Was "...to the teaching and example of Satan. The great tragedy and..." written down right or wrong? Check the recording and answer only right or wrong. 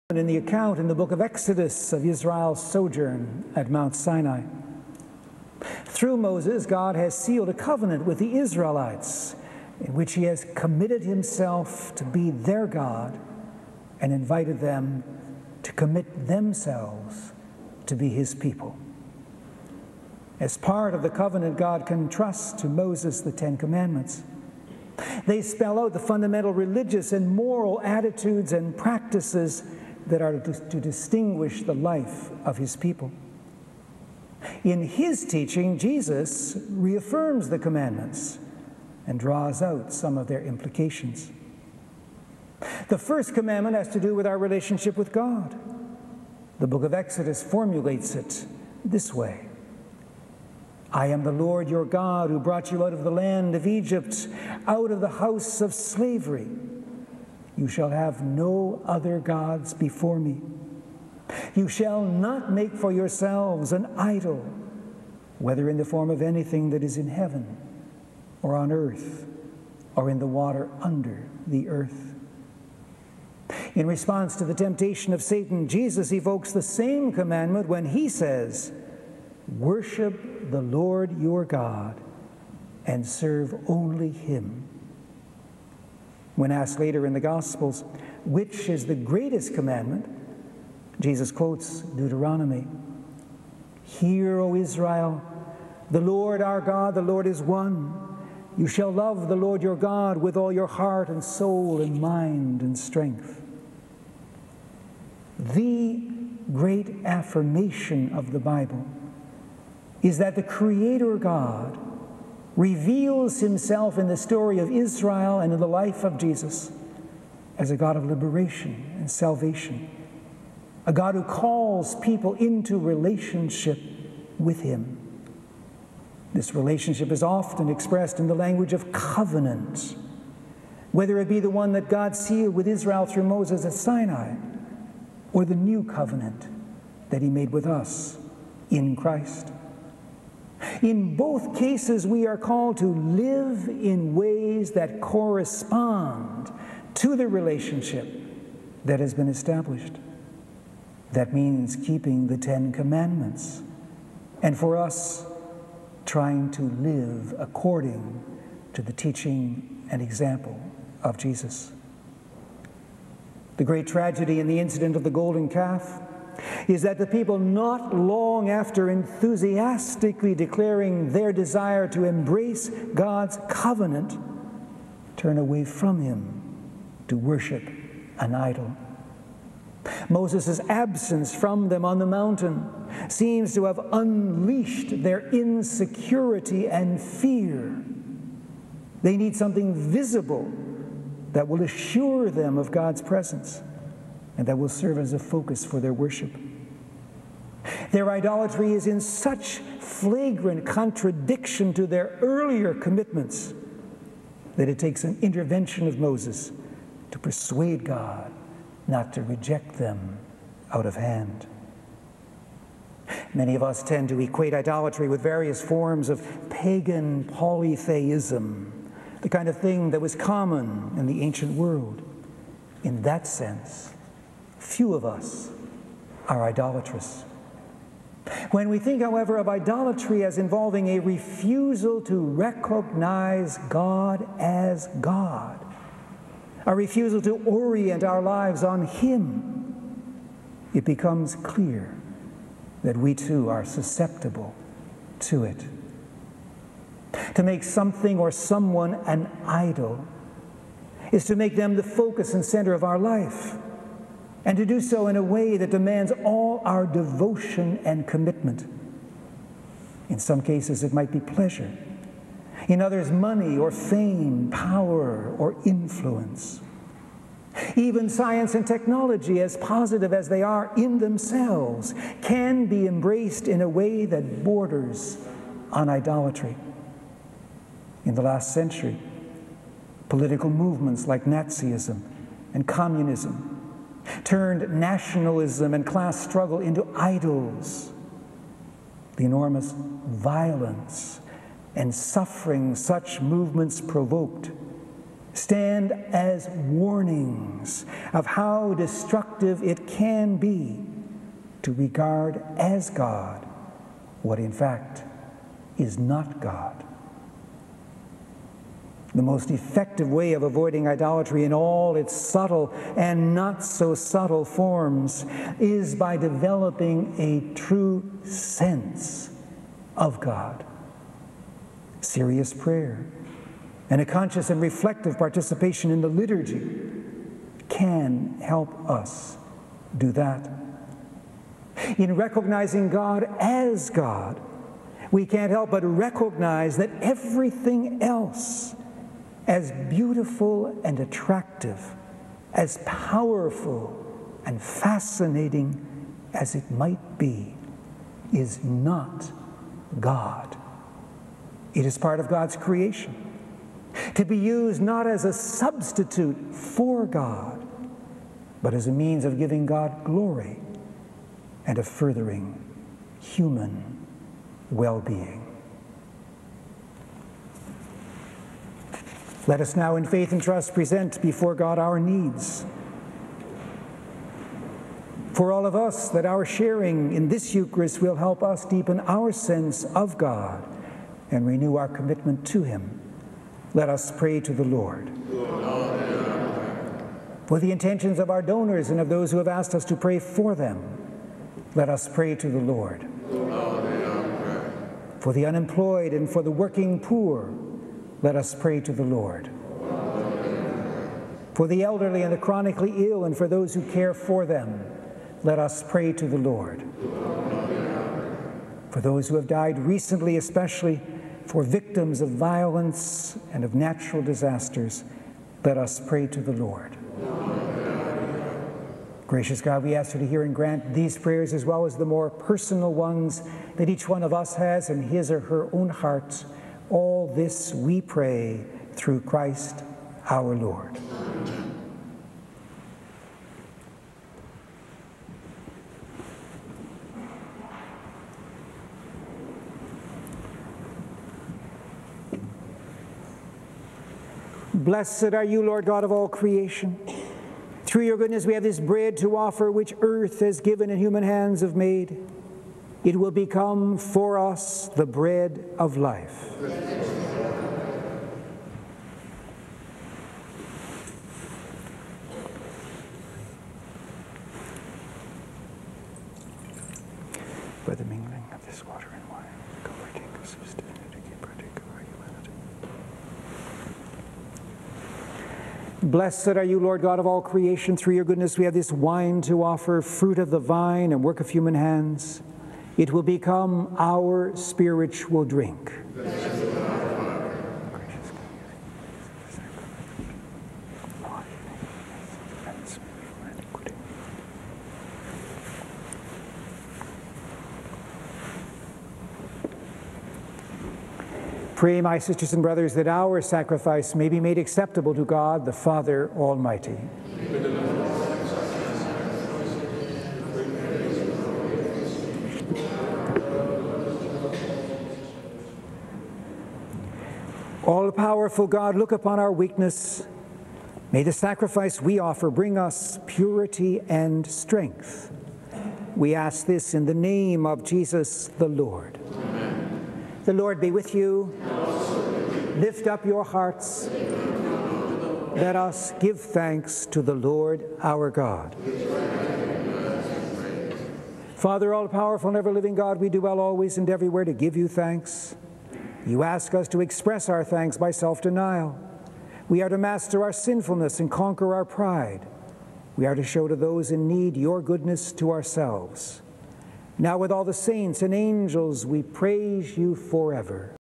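wrong.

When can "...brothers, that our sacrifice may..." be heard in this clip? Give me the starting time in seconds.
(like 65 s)
502 s.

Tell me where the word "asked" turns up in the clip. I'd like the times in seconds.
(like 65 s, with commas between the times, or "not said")
86 s, 389 s.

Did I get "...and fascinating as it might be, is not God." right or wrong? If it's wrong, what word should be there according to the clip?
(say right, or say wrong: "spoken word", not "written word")
right.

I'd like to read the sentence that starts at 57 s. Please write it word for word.
You shall have no other gods before me.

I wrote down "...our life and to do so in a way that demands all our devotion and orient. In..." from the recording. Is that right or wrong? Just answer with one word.
wrong.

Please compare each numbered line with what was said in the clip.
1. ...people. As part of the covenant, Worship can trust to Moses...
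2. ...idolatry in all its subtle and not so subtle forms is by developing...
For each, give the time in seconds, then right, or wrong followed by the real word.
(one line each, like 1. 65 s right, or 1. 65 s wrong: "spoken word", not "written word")
1. 18 s wrong: "God", not "Worship"
2. 310 s right.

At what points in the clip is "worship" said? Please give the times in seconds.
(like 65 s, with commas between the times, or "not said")
79 s, 177 s, 195 s.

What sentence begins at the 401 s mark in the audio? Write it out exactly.
For the elderly and the chronically ill, and for those who care for them, let us pray to the Lord.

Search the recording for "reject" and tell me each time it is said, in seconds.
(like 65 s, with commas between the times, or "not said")
209 s.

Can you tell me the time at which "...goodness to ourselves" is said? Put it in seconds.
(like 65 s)
554 s.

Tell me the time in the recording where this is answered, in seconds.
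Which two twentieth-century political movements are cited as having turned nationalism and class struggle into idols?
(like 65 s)
281 s.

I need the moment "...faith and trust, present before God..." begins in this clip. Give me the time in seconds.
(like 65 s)
370 s.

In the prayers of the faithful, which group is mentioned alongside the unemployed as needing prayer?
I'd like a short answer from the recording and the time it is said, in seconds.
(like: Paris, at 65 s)
the working poor, at 396 s.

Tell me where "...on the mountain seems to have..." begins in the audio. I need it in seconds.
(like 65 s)
181 s.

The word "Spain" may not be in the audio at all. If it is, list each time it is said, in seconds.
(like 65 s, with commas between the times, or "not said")
not said.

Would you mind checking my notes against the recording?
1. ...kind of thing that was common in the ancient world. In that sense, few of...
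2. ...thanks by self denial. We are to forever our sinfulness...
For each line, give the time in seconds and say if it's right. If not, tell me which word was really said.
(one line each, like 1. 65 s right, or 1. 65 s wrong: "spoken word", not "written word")
1. 219 s right
2. 547 s wrong: "master", not "forever".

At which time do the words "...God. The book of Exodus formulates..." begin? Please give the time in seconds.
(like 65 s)
45 s.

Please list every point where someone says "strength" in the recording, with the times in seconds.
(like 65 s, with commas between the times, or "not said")
102 s, 524 s.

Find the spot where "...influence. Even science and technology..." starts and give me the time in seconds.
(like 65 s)
265 s.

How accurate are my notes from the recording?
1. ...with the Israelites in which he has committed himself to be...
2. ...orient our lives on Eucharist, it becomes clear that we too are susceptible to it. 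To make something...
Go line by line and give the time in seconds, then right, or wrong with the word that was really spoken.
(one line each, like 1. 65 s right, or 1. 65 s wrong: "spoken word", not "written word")
1. 8 s right
2. 237 s wrong: "Him", not "Eucharist".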